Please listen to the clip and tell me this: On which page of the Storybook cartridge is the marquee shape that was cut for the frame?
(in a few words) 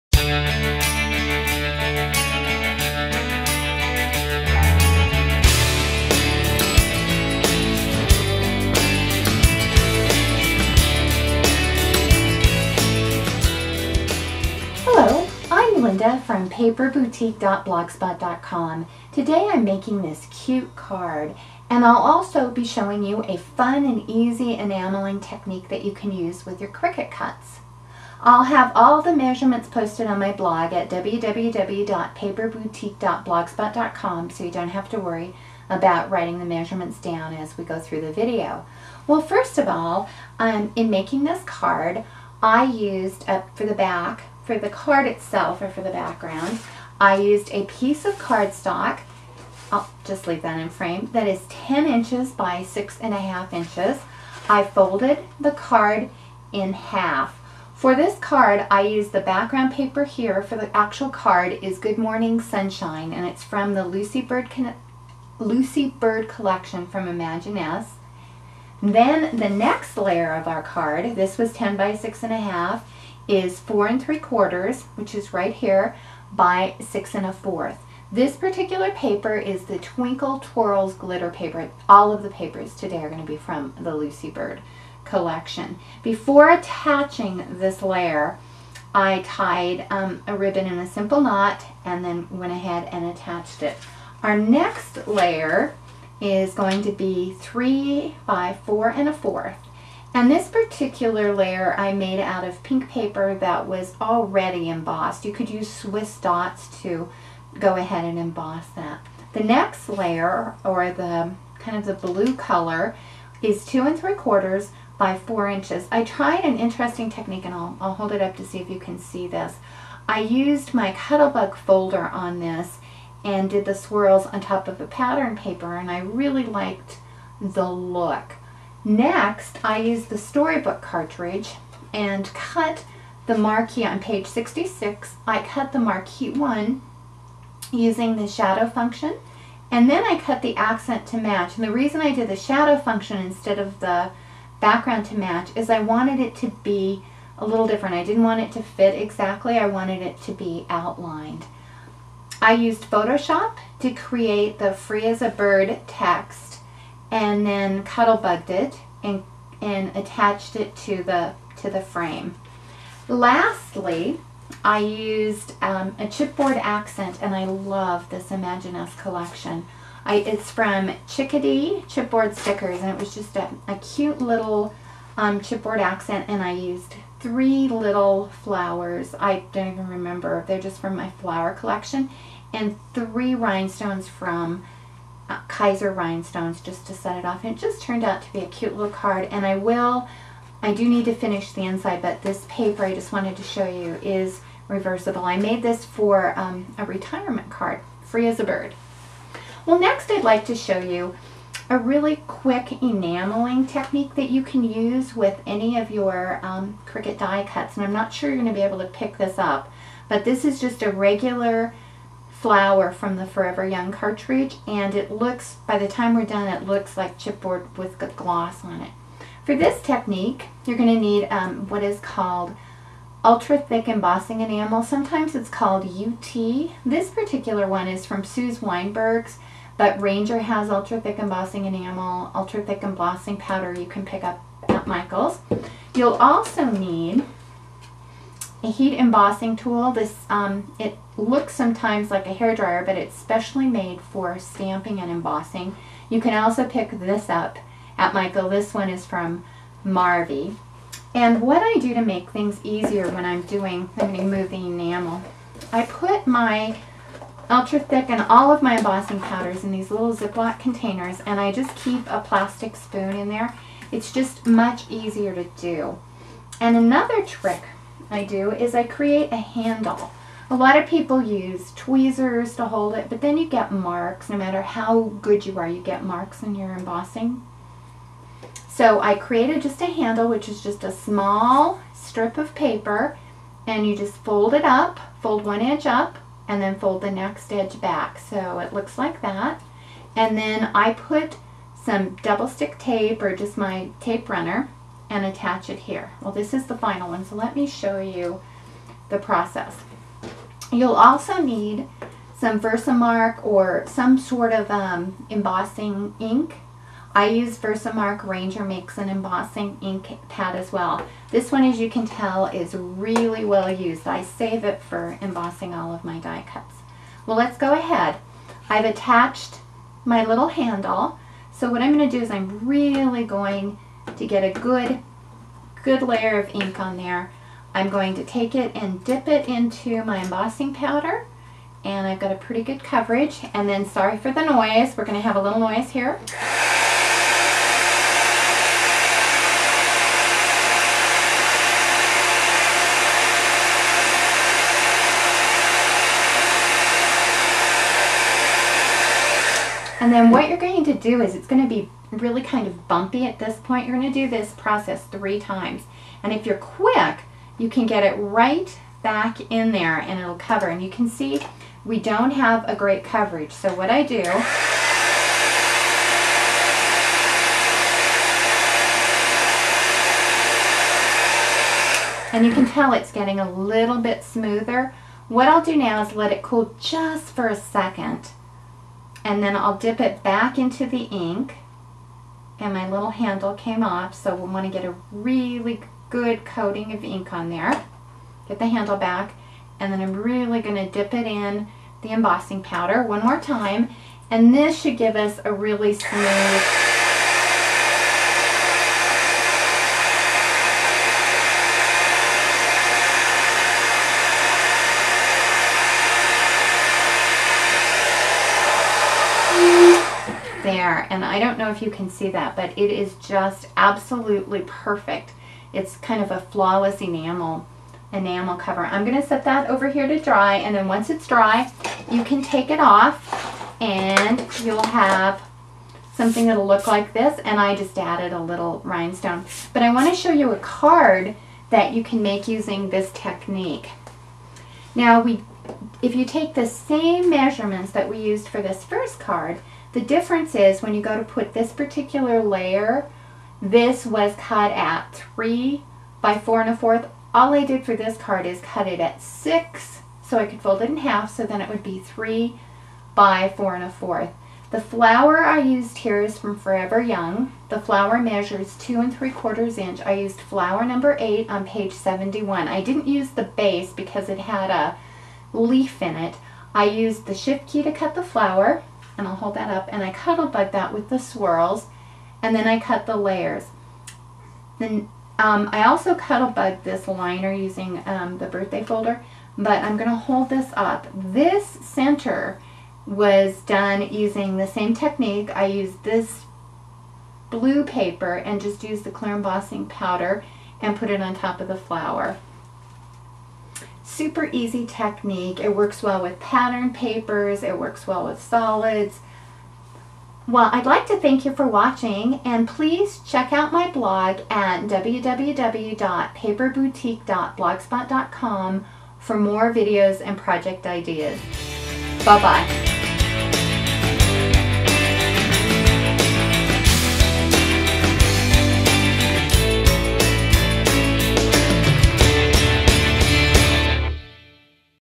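66.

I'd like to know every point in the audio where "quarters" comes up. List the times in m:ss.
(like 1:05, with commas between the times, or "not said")
1:14, 1:54, 7:39.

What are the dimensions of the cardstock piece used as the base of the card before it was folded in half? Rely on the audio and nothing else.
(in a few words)
10 by 6 1/2 inches.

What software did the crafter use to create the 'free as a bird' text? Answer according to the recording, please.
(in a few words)
Photoshop.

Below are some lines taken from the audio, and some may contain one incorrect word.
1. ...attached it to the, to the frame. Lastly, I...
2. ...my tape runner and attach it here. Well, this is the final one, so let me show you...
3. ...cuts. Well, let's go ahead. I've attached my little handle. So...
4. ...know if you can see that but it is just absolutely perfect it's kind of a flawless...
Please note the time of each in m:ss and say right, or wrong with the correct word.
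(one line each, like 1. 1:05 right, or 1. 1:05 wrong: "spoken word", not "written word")
1. 2:39 right
2. 4:53 right
3. 5:16 right
4. 6:51 right.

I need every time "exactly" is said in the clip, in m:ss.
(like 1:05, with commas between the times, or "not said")
2:28.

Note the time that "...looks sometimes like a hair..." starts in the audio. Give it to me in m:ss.
4:01.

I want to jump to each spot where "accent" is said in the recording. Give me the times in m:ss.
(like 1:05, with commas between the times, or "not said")
2:20, 2:46, 2:55.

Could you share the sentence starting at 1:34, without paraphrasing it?
Our next layer is going to be three by four and a fourth.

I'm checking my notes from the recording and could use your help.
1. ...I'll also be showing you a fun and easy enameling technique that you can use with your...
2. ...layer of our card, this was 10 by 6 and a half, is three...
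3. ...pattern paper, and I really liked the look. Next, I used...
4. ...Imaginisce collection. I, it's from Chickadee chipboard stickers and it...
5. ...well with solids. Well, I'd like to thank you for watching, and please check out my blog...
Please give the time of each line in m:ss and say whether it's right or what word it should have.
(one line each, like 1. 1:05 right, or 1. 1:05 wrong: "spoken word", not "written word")
1. 0:21 right
2. 1:09 wrong: "four", not "three"
3. 2:04 right
4. 2:48 right
5. 8:18 right.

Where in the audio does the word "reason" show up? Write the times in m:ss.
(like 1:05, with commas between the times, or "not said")
2:21.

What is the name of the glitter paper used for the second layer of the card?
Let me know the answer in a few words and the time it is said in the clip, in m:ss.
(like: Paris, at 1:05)
Twinkle Twirls, at 1:19.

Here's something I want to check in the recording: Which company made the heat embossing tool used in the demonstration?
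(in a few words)
Marvy.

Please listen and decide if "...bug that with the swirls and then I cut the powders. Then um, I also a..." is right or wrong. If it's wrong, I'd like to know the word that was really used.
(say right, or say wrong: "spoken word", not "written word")
wrong: "layers", not "powders".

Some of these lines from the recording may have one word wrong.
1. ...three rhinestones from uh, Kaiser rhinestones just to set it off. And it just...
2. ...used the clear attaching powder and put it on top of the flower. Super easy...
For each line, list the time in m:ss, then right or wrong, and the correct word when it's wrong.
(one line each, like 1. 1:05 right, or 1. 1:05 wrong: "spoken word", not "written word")
1. 3:02 right
2. 8:08 wrong: "embossing", not "attaching".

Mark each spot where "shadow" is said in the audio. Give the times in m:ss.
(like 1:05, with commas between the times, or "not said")
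2:18, 2:22.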